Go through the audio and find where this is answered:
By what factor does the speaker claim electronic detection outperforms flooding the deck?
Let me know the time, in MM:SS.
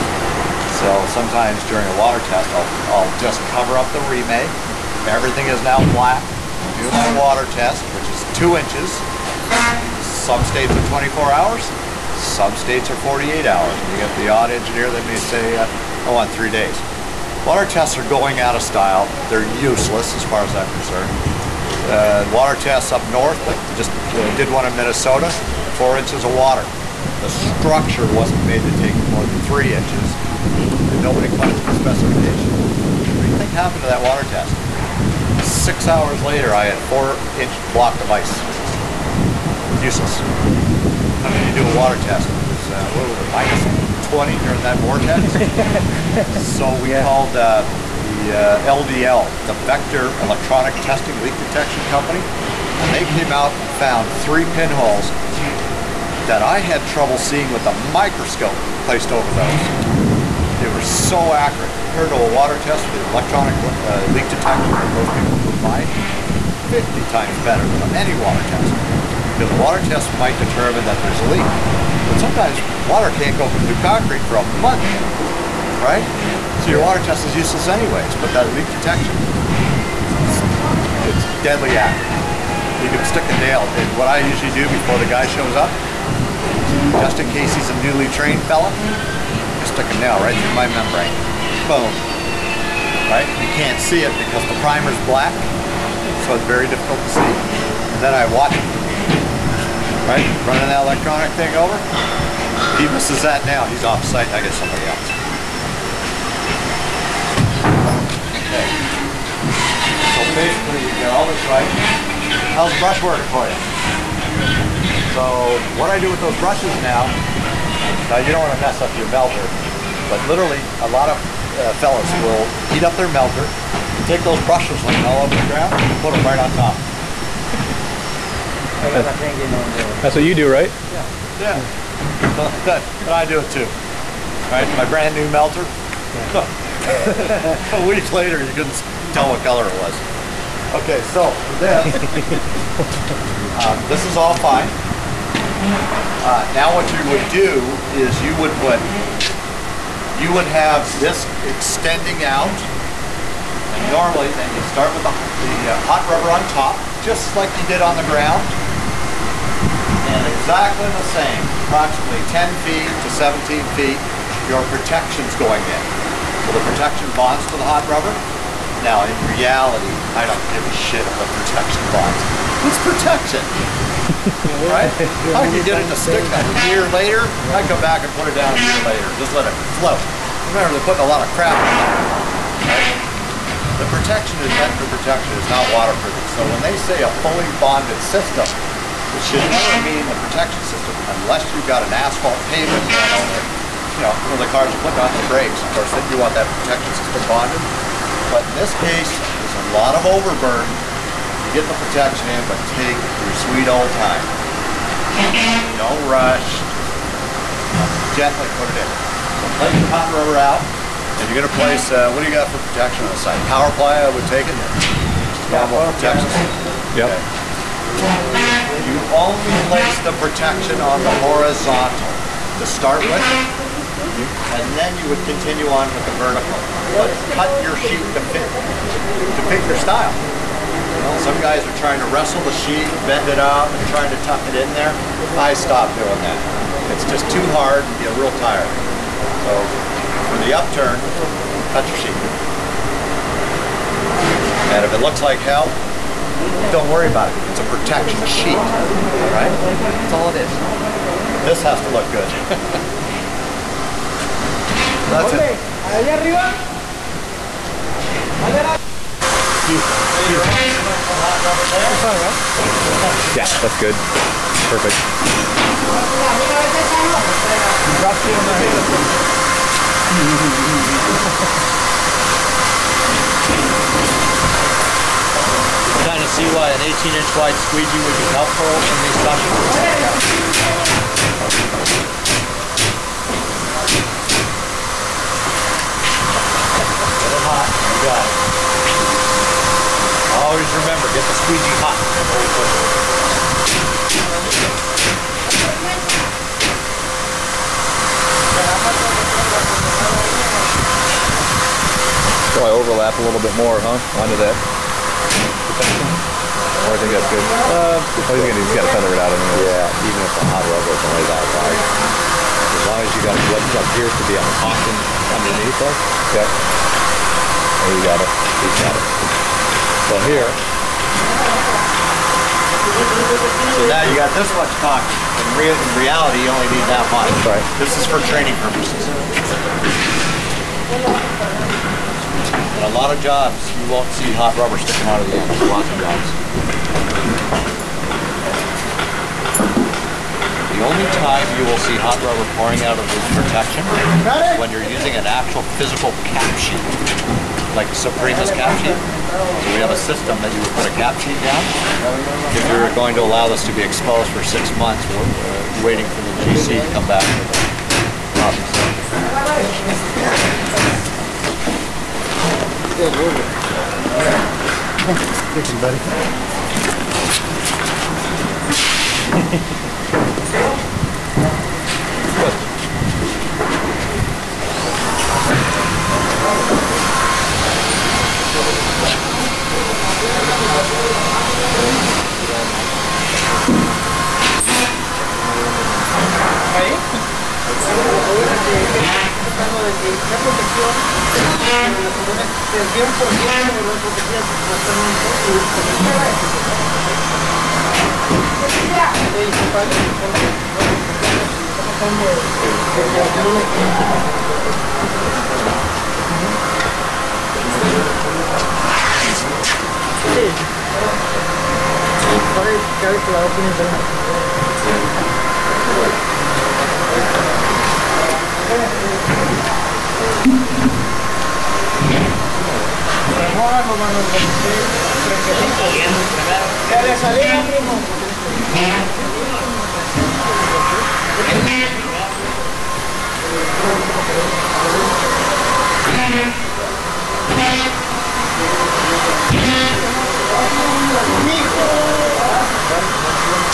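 01:06.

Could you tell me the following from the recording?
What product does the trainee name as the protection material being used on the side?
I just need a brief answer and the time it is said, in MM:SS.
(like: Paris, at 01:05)
Power ply, at 03:33.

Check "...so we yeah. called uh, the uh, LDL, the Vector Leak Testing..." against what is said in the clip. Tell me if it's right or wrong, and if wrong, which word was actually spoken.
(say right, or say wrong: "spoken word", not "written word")
wrong: "Electronic", not "Leak".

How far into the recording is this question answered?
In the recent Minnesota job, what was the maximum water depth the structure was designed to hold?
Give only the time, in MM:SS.
00:29.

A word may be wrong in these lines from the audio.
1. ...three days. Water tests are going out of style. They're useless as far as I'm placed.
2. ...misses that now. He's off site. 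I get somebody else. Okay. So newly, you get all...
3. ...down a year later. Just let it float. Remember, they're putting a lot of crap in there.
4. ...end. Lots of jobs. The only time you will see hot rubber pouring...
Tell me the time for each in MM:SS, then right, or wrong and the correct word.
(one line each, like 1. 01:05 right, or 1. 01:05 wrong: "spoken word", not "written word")
1. 00:16 wrong: "concerned", not "placed"
2. 01:42 wrong: "basically", not "newly"
3. 02:58 right
4. 05:35 right.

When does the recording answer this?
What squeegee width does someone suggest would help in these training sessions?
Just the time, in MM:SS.
04:36.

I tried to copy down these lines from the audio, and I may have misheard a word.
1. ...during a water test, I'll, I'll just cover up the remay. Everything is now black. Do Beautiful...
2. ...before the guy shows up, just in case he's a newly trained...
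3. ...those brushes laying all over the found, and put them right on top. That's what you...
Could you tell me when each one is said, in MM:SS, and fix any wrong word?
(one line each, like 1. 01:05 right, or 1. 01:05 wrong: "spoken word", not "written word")
1. 00:01 right
2. 01:24 right
3. 02:04 wrong: "ground", not "found".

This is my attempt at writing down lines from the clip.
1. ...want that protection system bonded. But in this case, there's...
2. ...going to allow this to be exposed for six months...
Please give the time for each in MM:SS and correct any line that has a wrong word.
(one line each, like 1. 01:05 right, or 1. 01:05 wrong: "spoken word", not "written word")
1. 03:16 right
2. 05:52 right.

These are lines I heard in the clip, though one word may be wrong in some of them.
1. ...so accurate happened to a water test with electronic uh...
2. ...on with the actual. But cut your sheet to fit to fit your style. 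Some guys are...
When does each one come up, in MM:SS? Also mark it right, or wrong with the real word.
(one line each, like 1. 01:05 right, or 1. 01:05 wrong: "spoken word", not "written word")
1. 01:00 wrong: "compared", not "happened"
2. 03:45 wrong: "vertical", not "actual".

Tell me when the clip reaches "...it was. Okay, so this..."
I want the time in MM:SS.
02:19.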